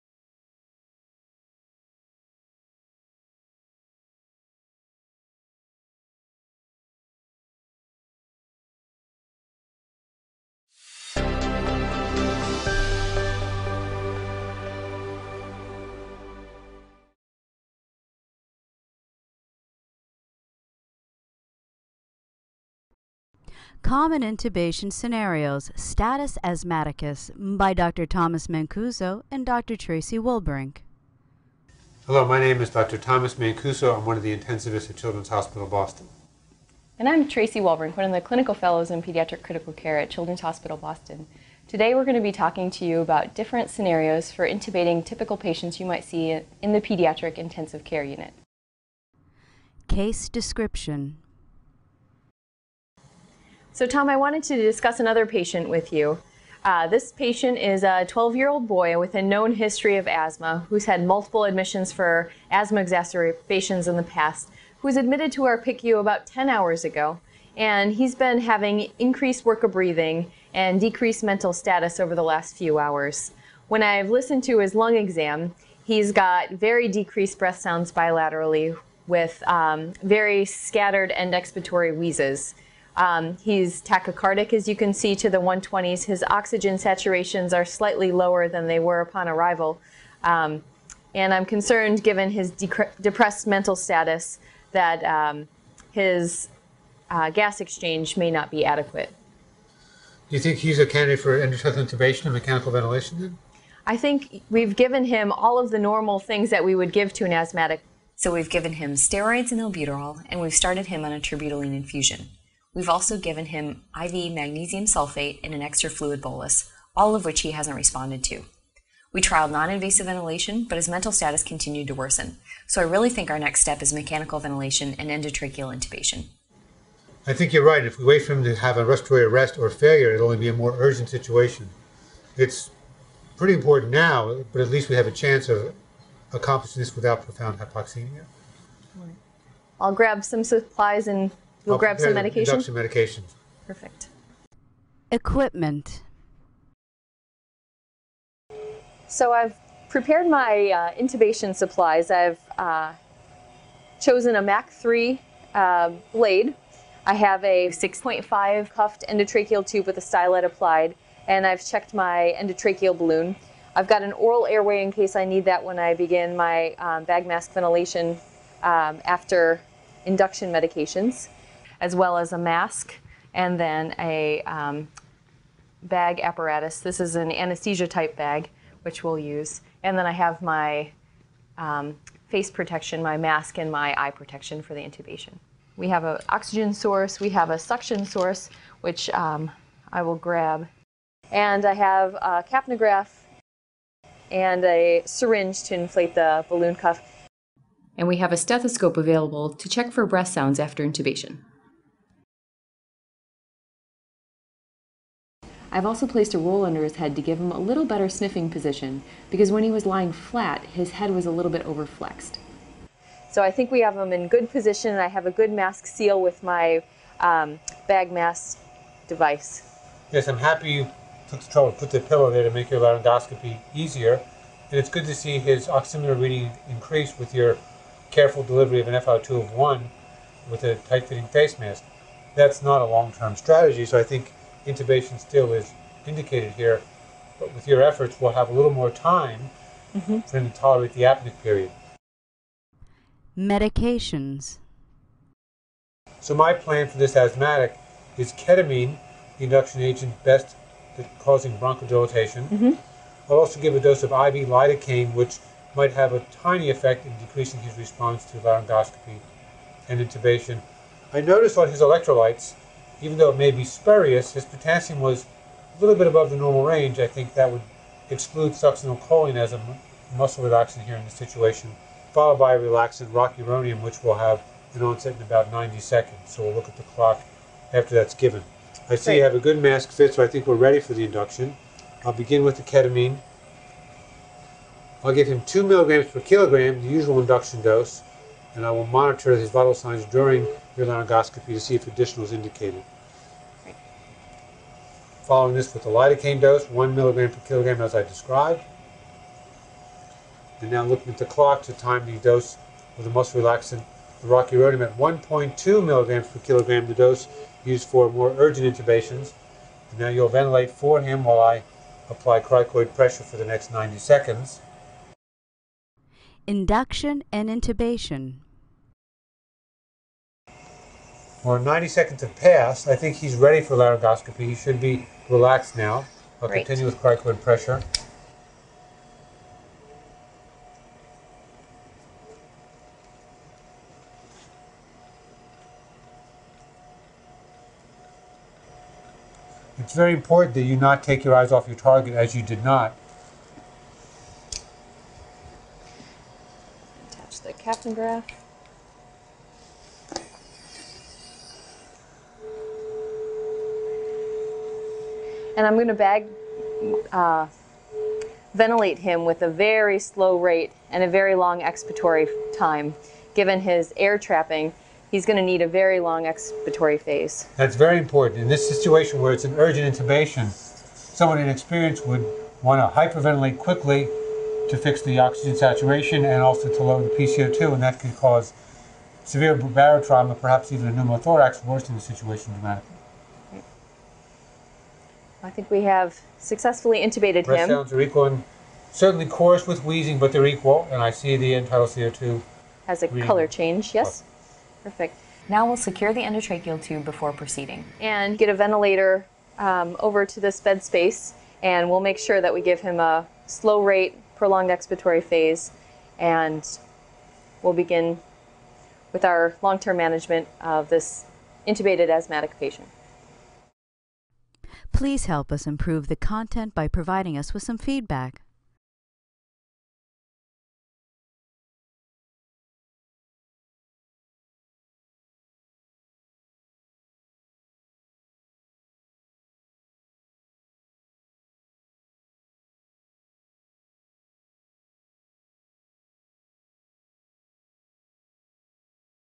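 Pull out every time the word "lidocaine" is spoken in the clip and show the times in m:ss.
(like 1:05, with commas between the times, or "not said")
4:14, 4:55.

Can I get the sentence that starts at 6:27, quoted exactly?
Breath sounds are equal and certainly coarse with wheezing, but they're equal, and I see the end tidal CO2.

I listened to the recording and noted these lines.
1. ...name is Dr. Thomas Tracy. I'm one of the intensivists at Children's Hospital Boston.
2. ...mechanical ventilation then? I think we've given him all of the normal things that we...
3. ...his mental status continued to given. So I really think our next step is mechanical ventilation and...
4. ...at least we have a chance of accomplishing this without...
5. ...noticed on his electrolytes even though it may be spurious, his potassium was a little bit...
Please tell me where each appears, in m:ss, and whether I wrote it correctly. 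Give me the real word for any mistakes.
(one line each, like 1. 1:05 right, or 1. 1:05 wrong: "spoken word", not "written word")
1. 0:32 wrong: "Mancuso", not "Tracy"
2. 1:42 right
3. 2:00 wrong: "worsen", not "given"
4. 2:14 right
5. 4:21 right.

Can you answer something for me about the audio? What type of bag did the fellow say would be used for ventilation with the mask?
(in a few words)
anesthesia type bag.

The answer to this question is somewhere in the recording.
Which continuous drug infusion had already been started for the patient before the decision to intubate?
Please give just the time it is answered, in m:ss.
1:51.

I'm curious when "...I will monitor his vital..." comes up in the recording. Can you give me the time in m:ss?
4:48.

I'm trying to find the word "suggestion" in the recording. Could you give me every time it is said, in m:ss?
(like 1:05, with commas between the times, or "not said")
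not said.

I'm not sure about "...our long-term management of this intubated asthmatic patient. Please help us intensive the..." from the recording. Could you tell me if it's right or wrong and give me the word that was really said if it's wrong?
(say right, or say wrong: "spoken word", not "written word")
wrong: "improve", not "intensive".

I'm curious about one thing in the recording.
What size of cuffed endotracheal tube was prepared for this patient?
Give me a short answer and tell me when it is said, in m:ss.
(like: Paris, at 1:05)
6.5, at 2:37.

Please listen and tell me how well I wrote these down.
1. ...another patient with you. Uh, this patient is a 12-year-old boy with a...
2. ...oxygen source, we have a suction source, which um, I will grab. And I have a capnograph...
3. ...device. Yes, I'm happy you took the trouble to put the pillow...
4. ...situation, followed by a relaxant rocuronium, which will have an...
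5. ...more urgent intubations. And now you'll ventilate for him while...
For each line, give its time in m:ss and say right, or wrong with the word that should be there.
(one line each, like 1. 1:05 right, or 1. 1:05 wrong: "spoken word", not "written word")
1. 0:54 right
2. 3:06 right
3. 3:39 right
4. 4:31 right
5. 5:08 right.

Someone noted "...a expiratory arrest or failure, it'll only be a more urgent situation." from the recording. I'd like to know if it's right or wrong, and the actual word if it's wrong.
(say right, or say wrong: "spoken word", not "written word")
wrong: "respiratory", not "expiratory".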